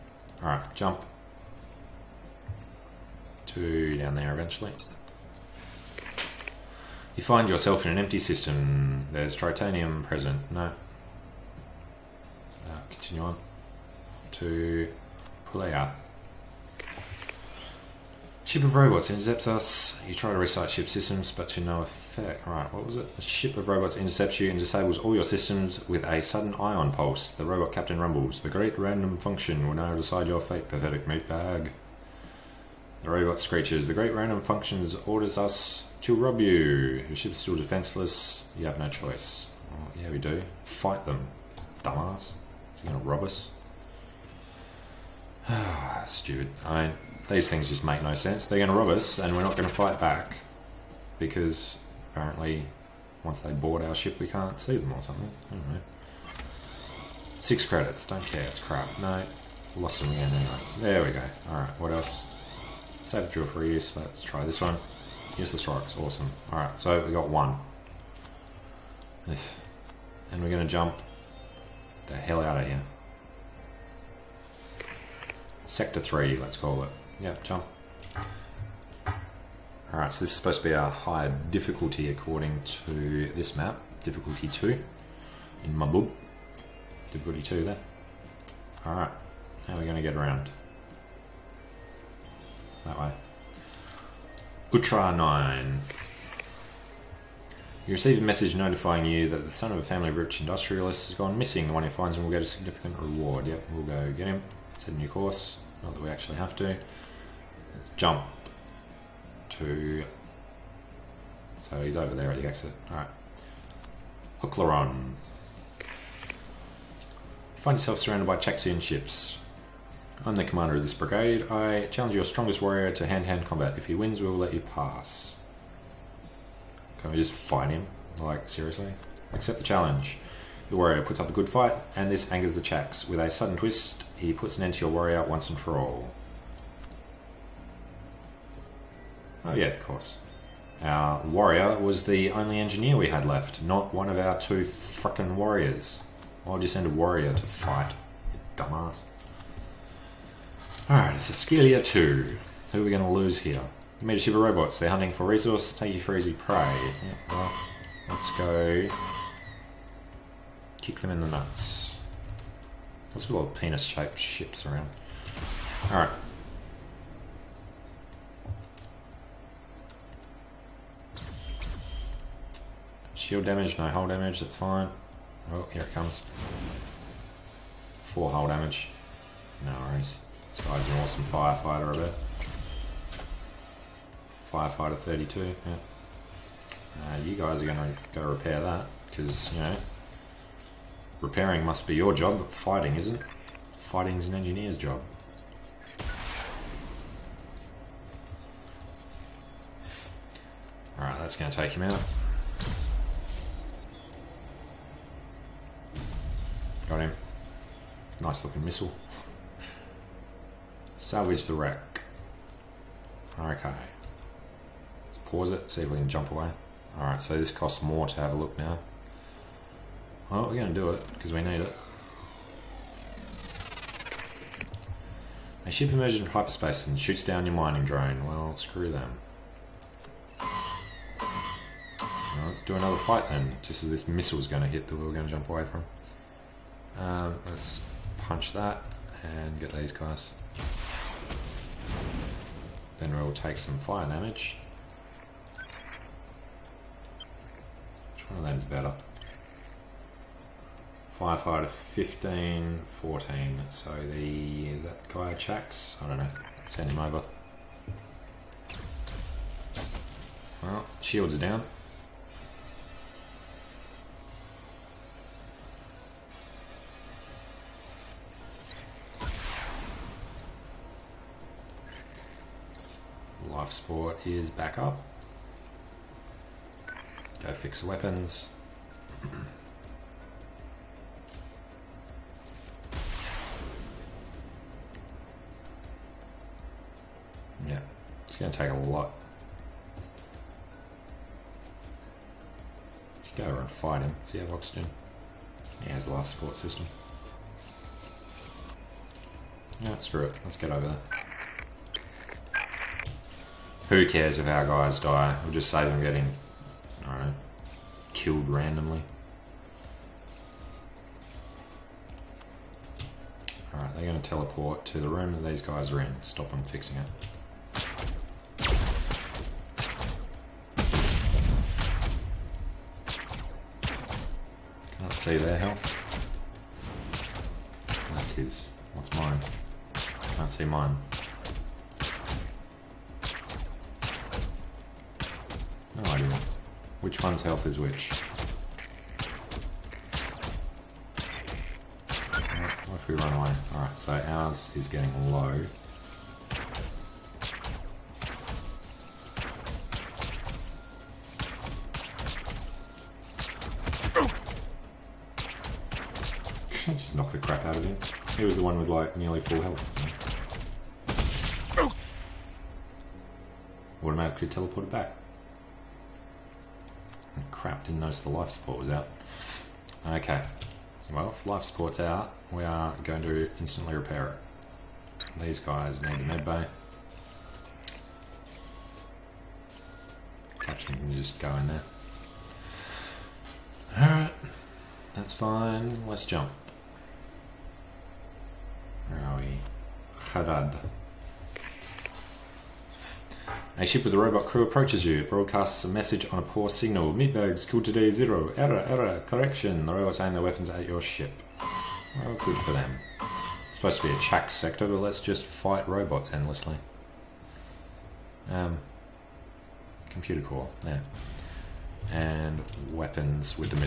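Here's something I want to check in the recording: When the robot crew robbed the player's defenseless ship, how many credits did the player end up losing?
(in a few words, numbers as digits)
6.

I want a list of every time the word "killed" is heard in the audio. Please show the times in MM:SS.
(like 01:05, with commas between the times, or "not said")
05:08, 06:37.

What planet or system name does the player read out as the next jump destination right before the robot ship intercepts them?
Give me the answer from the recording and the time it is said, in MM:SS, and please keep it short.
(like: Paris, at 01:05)
Pulea, at 00:15.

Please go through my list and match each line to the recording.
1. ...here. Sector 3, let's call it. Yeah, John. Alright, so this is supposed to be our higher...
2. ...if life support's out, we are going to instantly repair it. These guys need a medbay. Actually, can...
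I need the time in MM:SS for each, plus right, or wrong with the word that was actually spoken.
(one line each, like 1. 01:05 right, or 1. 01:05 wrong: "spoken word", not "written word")
1. 01:12 right
2. 06:11 right.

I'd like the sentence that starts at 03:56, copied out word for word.
Um, let's punch that and get these guys.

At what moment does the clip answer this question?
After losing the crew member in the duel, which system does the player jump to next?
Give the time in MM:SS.
02:31.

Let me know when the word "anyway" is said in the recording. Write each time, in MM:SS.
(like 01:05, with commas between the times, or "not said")
01:00.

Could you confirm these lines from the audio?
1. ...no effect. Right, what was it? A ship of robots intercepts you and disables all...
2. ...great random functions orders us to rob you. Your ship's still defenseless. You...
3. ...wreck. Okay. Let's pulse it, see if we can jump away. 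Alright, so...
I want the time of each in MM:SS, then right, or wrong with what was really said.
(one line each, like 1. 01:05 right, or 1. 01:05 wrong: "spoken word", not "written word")
1. 00:21 right
2. 00:33 right
3. 03:31 wrong: "pause", not "pulse".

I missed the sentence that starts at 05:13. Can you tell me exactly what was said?
Alright, they're going to teleport to the room that these guys are in.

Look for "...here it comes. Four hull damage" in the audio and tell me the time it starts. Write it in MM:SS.
02:55.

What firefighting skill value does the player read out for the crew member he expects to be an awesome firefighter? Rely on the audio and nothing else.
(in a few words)
32.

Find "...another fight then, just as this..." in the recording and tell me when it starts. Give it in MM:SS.
03:52.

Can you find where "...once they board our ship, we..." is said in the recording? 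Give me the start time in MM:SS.
00:53.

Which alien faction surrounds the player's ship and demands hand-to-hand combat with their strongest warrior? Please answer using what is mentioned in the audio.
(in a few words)
Chaxian.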